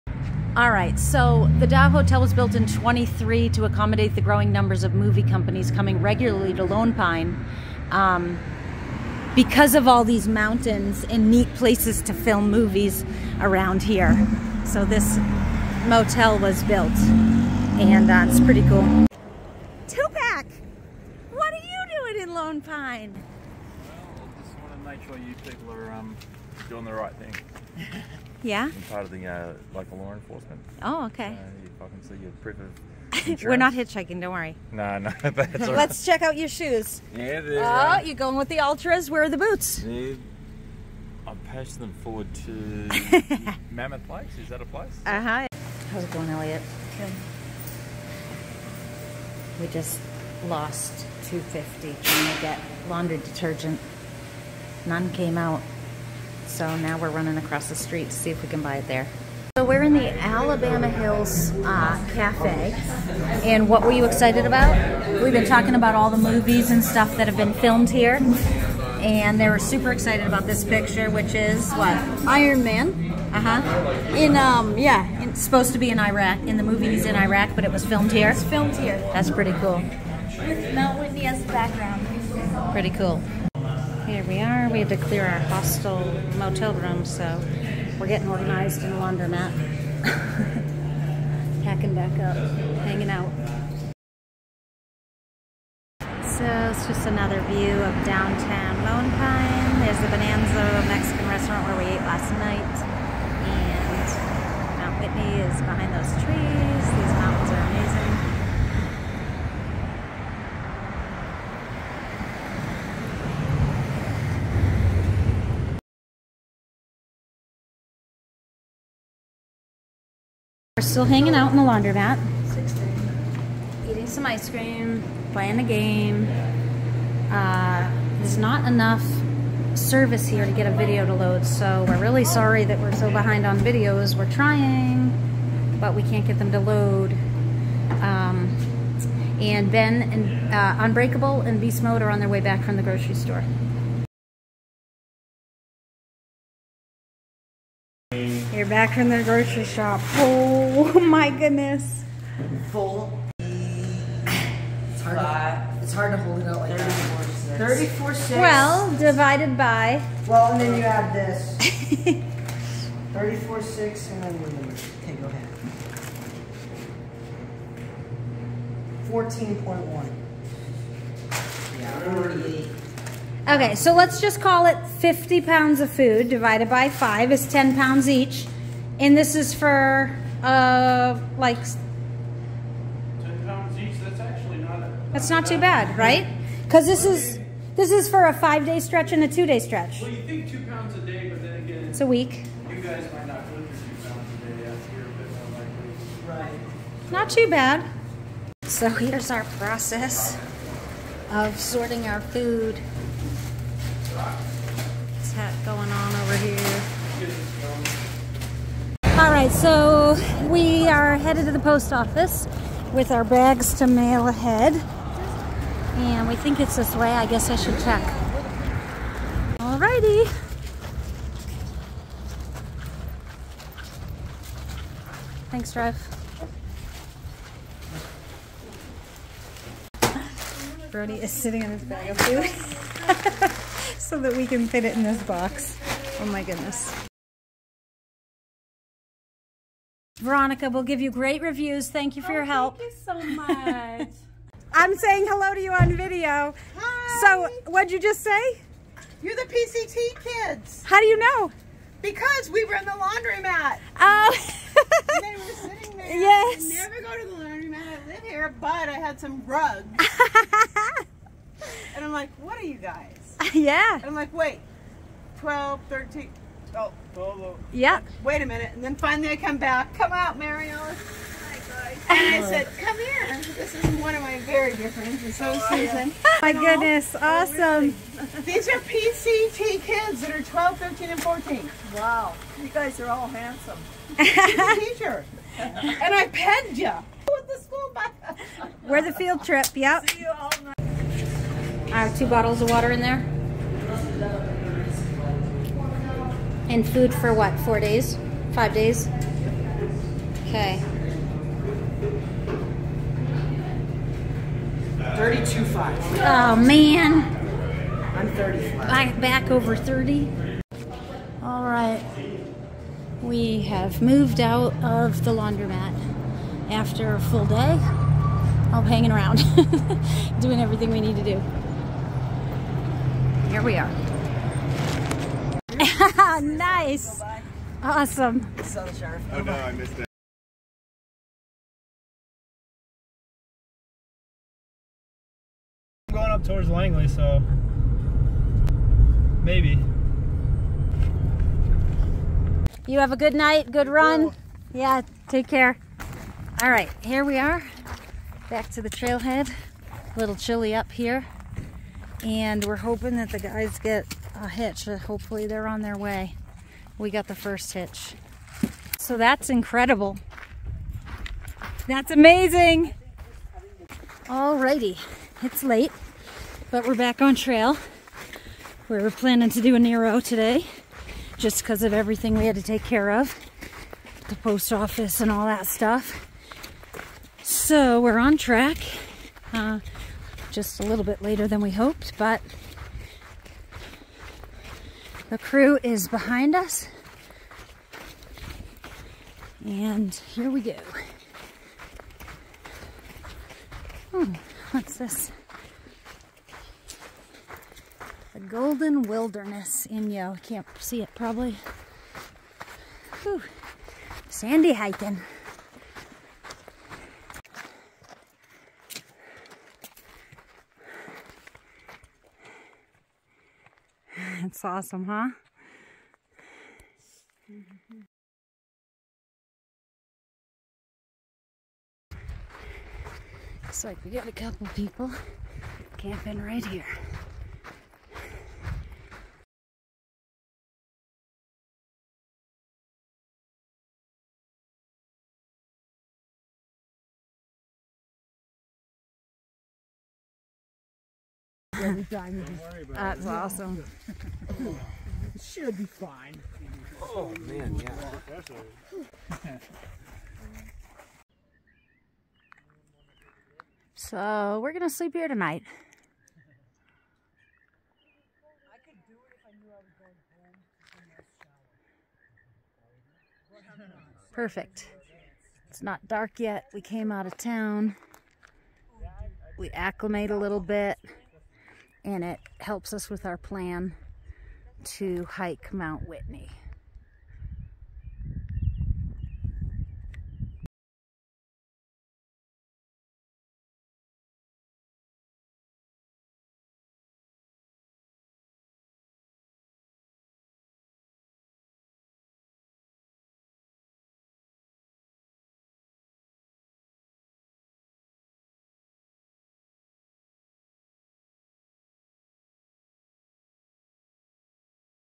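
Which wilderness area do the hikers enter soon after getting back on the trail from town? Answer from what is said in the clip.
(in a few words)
Golden Wilderness.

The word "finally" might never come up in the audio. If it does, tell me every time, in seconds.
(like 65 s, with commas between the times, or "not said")
268 s.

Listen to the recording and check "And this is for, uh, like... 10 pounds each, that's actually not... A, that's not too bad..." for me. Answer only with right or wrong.
right.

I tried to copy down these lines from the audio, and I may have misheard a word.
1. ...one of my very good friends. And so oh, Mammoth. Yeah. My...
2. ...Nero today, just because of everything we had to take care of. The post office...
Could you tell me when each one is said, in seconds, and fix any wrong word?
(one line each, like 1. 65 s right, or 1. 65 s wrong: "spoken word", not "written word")
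1. 274 s wrong: "Susan", not "Mammoth"
2. 369 s right.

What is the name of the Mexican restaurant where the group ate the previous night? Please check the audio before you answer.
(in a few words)
Bonanza.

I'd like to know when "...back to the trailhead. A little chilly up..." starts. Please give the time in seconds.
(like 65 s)
348 s.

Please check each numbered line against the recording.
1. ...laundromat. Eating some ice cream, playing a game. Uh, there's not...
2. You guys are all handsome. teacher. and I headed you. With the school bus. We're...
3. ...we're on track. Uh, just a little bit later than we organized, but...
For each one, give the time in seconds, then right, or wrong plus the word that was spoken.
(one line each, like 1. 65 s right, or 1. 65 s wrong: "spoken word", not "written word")
1. 121 s right
2. 282 s wrong: "penned", not "headed"
3. 377 s wrong: "hoped", not "organized".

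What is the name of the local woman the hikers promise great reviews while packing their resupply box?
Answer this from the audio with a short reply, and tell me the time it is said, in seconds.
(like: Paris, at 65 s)
Veronica, at 240 s.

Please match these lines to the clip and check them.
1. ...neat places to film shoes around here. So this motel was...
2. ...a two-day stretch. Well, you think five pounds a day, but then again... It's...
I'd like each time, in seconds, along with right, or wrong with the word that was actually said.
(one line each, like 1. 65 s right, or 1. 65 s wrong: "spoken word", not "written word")
1. 11 s wrong: "movies", not "shoes"
2. 189 s wrong: "two", not "five".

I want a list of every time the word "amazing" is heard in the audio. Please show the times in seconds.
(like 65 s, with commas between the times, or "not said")
107 s, 362 s.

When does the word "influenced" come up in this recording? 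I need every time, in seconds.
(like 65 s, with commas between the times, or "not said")
not said.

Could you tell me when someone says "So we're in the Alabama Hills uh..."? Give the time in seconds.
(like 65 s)
59 s.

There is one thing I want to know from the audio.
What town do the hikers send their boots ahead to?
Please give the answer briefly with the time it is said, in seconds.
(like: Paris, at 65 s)
Mammoth Lakes, at 43 s.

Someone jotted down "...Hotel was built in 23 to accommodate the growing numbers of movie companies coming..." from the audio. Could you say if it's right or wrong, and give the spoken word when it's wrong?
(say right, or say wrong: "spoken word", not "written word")
right.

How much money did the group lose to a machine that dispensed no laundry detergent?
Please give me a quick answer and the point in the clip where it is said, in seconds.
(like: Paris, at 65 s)
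250, at 51 s.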